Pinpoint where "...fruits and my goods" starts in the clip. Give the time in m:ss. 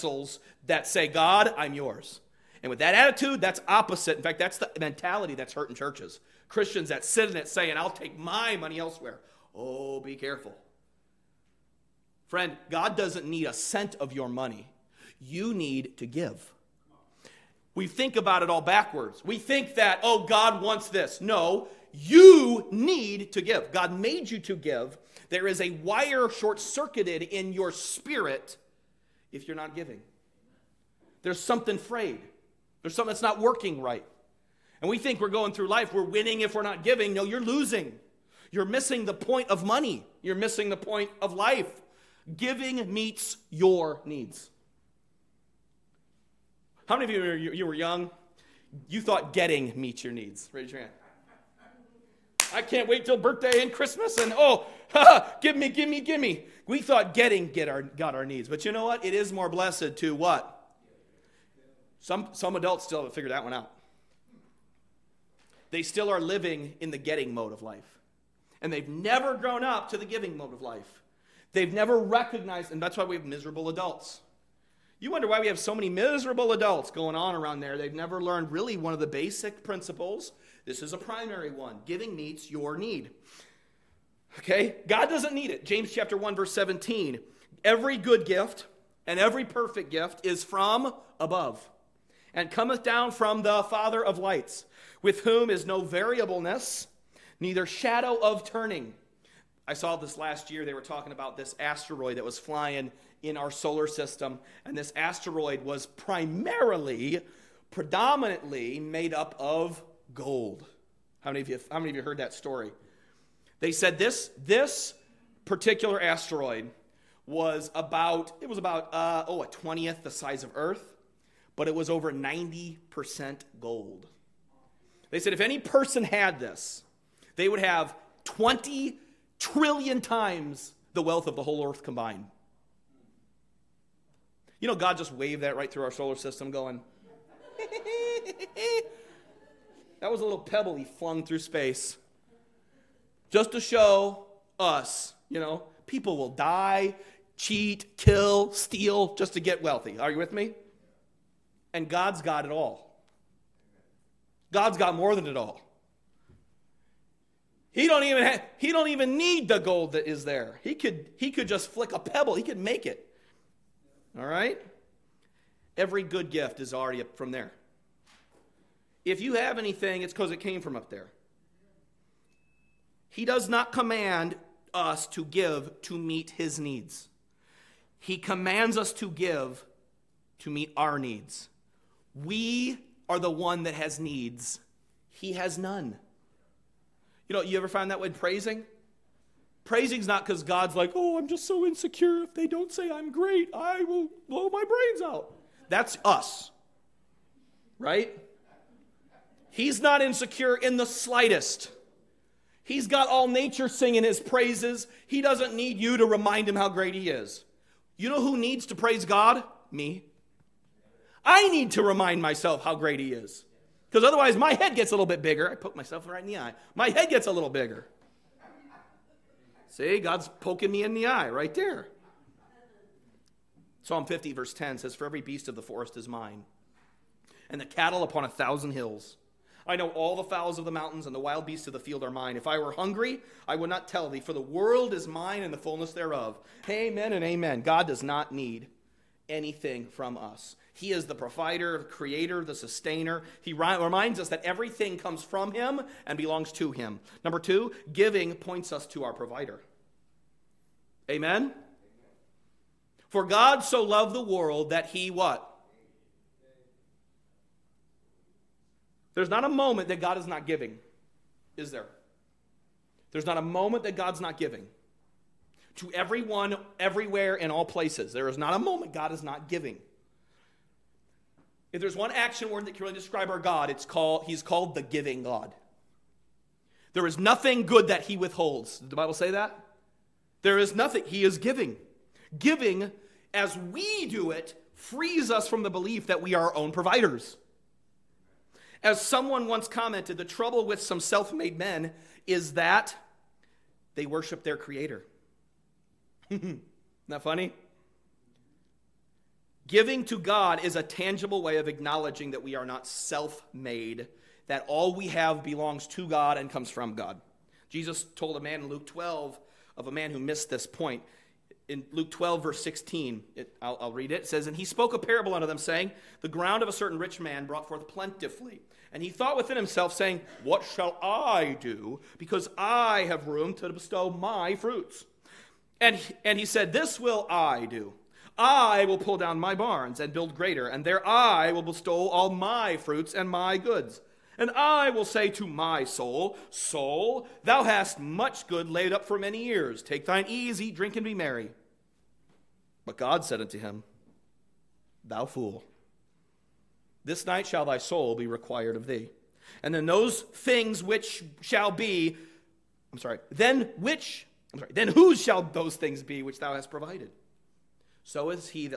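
5:32.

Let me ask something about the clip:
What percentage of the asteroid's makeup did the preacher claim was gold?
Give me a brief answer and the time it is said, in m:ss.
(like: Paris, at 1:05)
over 90%, at 2:01.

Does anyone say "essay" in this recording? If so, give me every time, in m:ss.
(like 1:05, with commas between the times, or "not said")
not said.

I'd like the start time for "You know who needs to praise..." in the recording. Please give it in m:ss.
3:27.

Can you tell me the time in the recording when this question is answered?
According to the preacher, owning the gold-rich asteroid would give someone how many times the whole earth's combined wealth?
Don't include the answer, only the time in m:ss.
2:08.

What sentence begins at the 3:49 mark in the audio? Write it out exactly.
I know all the fowls of the mountains and the wild beasts of the field are mine.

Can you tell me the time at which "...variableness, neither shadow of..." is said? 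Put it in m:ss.
1:35.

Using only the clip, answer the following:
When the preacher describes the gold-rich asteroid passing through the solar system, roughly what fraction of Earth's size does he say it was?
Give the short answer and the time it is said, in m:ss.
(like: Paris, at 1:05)
1/20, at 1:59.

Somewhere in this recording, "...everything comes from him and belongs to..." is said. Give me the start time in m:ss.
4:04.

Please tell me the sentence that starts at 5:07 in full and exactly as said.
Jesus told a man in Luke 12 of a man who missed this point.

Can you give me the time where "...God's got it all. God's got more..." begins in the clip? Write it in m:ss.
2:31.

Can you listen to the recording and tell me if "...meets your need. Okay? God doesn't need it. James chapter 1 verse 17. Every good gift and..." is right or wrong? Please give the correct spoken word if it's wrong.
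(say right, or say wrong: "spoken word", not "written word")
right.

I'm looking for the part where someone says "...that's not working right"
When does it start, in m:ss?
0:33.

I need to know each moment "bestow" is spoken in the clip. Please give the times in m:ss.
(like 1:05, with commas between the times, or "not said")
5:23, 5:31.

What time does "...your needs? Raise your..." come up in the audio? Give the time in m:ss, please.
0:50.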